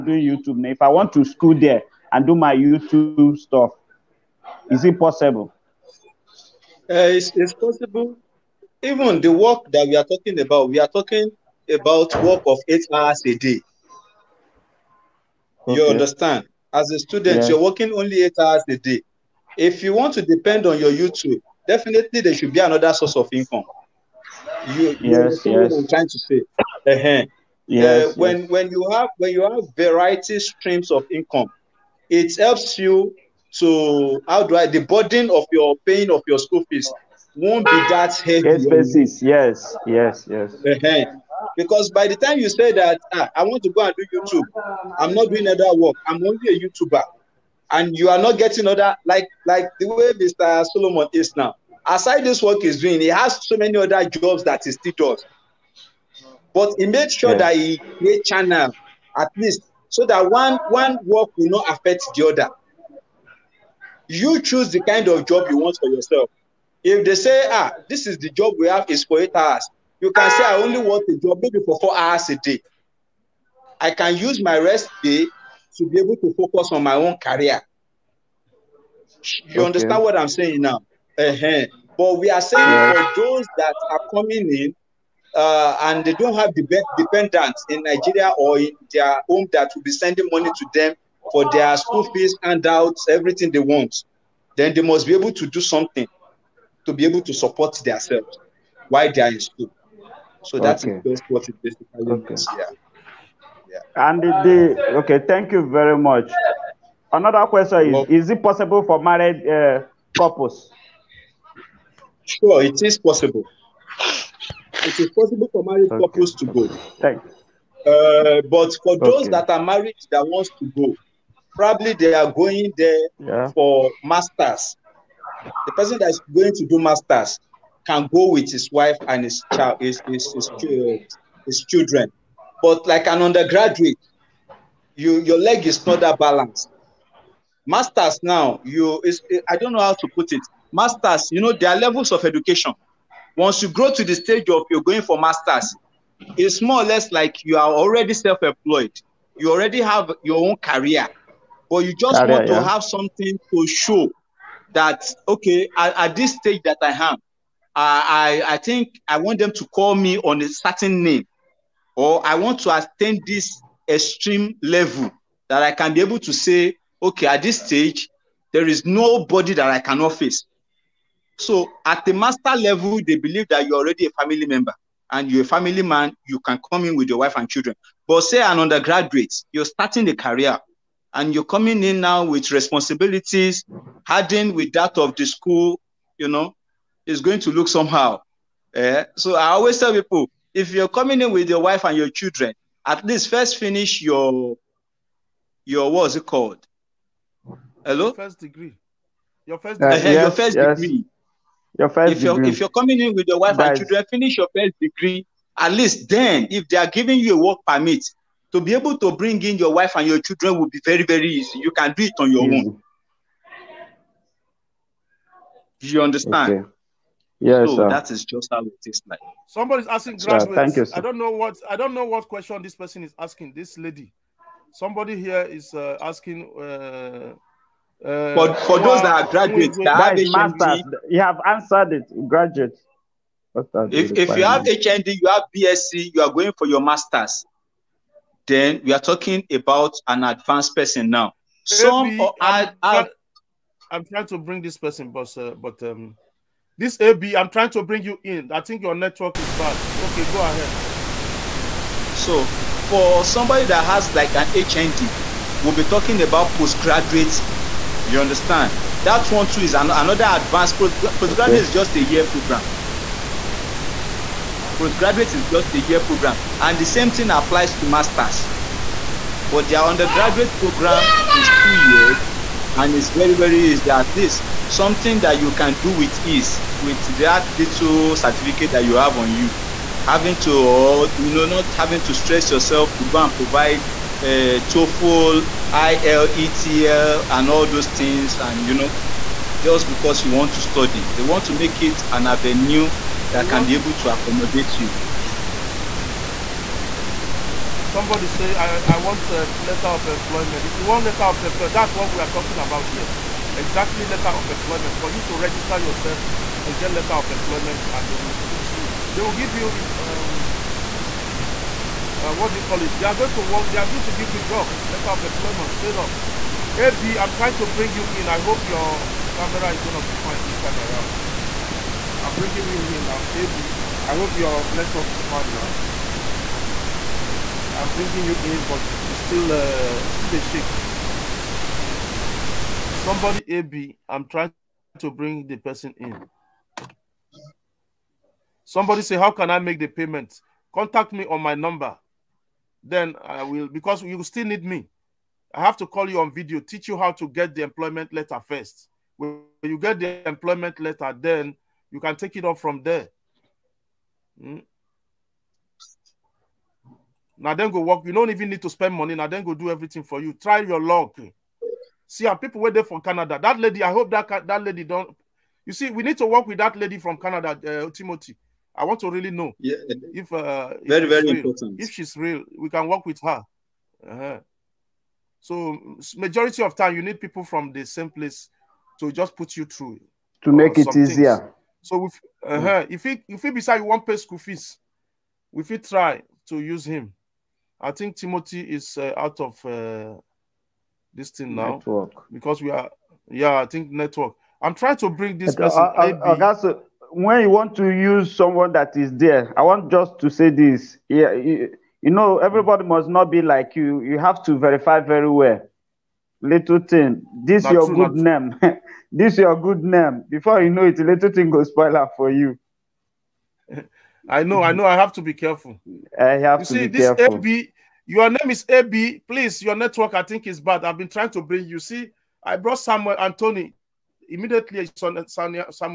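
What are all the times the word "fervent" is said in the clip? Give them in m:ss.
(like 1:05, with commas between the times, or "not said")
not said.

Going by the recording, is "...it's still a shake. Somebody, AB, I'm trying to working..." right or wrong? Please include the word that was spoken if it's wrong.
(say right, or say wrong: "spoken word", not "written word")
wrong: "bring", not "working".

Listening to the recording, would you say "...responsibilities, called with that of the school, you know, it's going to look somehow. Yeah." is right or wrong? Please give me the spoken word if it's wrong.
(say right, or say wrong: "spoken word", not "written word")
wrong: "hardened", not "called".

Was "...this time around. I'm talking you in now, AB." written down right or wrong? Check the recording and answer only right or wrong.
wrong.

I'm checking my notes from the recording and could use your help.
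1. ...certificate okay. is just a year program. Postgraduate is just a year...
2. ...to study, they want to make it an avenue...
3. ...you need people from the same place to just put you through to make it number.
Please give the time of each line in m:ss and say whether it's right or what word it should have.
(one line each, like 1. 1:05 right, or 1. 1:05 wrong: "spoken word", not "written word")
1. 4:20 wrong: "postgraduate", not "certificate"
2. 4:50 right
3. 6:16 wrong: "easier", not "number".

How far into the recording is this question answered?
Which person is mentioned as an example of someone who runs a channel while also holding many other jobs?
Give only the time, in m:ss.
0:50.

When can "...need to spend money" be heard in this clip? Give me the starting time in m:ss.
5:58.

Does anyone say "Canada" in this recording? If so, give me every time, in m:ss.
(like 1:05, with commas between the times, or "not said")
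6:03, 6:07.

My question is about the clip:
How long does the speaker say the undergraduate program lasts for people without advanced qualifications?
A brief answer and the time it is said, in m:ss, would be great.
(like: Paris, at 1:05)
2 years, at 4:31.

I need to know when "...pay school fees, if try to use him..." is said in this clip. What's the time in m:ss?
6:24.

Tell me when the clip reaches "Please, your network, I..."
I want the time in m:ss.
6:59.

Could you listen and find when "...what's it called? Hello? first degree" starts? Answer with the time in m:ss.
3:15.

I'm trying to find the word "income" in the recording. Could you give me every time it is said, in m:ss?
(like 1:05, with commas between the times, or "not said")
0:23, 0:31.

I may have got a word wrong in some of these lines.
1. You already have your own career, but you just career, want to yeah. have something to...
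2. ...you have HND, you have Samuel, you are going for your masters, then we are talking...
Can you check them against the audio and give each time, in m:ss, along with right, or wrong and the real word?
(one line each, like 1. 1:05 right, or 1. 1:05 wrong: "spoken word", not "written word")
1. 2:29 right
2. 3:54 wrong: "BSc", not "Samuel".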